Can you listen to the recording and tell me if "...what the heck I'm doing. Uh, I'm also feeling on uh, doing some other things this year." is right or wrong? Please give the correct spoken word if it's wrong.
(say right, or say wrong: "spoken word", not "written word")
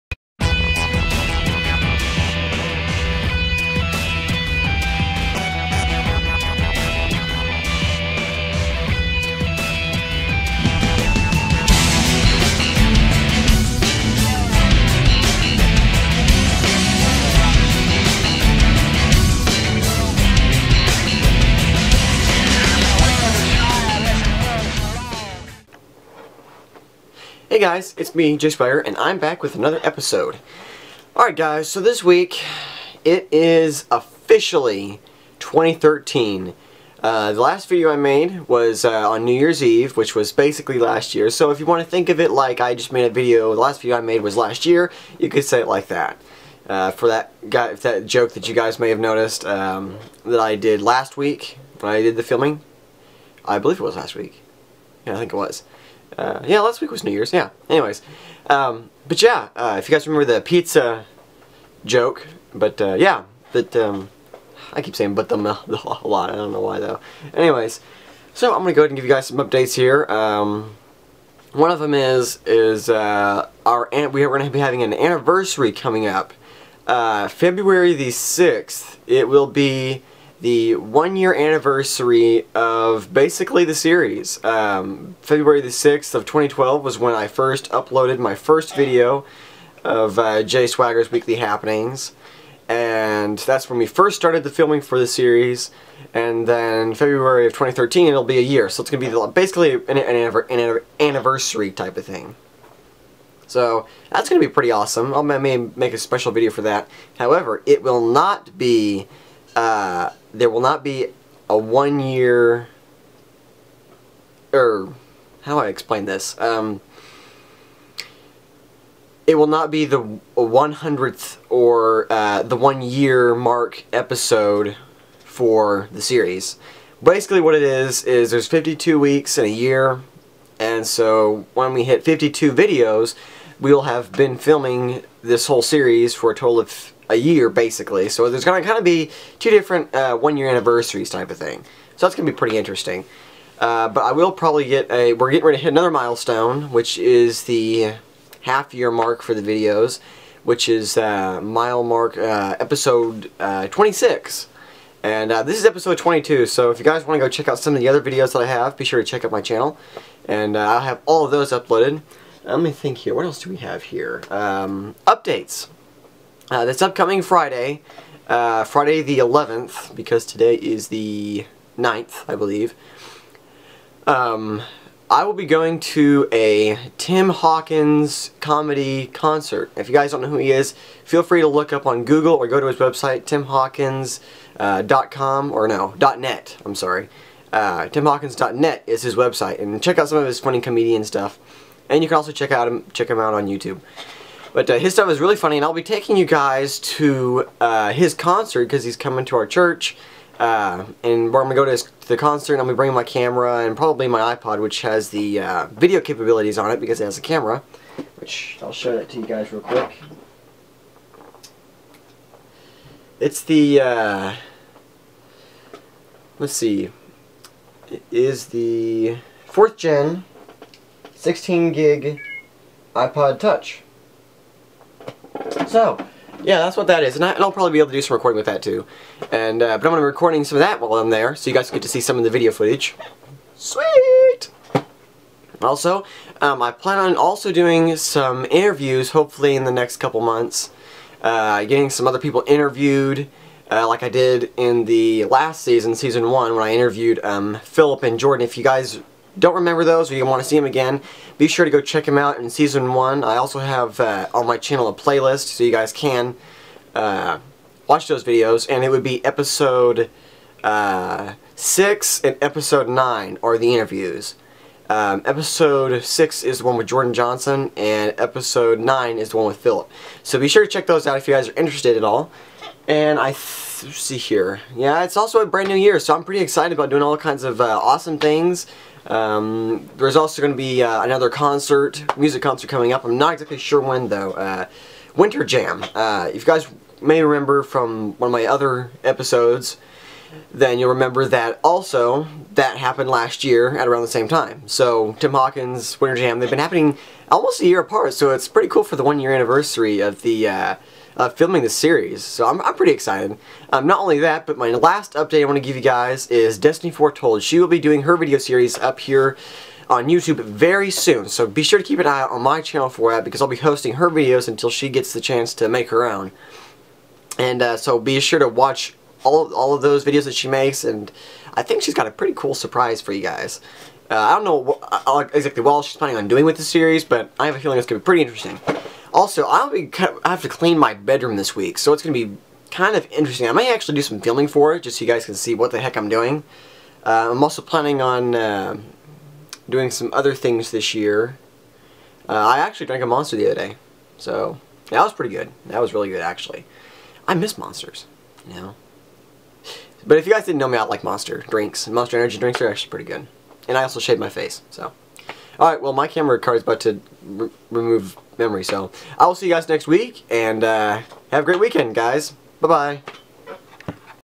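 wrong: "planning", not "feeling".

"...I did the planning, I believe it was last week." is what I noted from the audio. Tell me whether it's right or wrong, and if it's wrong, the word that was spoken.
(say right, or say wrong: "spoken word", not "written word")
wrong: "filming", not "planning".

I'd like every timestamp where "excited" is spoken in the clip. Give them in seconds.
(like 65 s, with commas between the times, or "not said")
276 s, 302 s.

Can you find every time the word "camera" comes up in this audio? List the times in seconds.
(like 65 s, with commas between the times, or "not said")
203 s, 207 s, 356 s.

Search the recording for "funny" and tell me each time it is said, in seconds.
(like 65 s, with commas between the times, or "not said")
190 s, 195 s.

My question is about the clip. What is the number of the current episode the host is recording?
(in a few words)
22.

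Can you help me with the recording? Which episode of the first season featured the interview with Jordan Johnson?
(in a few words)
6.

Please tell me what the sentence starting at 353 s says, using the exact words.
And I also shaved my face, so...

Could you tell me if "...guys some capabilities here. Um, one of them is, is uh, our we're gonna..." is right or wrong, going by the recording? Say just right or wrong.
wrong.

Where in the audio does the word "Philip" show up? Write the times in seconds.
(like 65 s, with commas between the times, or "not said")
247 s, 269 s.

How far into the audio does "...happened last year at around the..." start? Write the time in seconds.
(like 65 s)
292 s.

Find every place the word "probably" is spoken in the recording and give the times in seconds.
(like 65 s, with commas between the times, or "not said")
144 s, 203 s, 227 s.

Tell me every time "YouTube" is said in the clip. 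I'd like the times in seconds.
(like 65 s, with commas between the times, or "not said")
193 s, 310 s.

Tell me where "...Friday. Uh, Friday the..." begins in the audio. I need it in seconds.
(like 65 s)
167 s.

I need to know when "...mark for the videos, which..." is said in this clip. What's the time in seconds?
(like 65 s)
148 s.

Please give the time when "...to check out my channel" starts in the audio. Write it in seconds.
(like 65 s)
159 s.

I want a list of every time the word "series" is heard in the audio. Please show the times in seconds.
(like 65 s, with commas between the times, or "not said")
83 s, 95 s, 126 s, 135 s, 301 s, 308 s, 326 s.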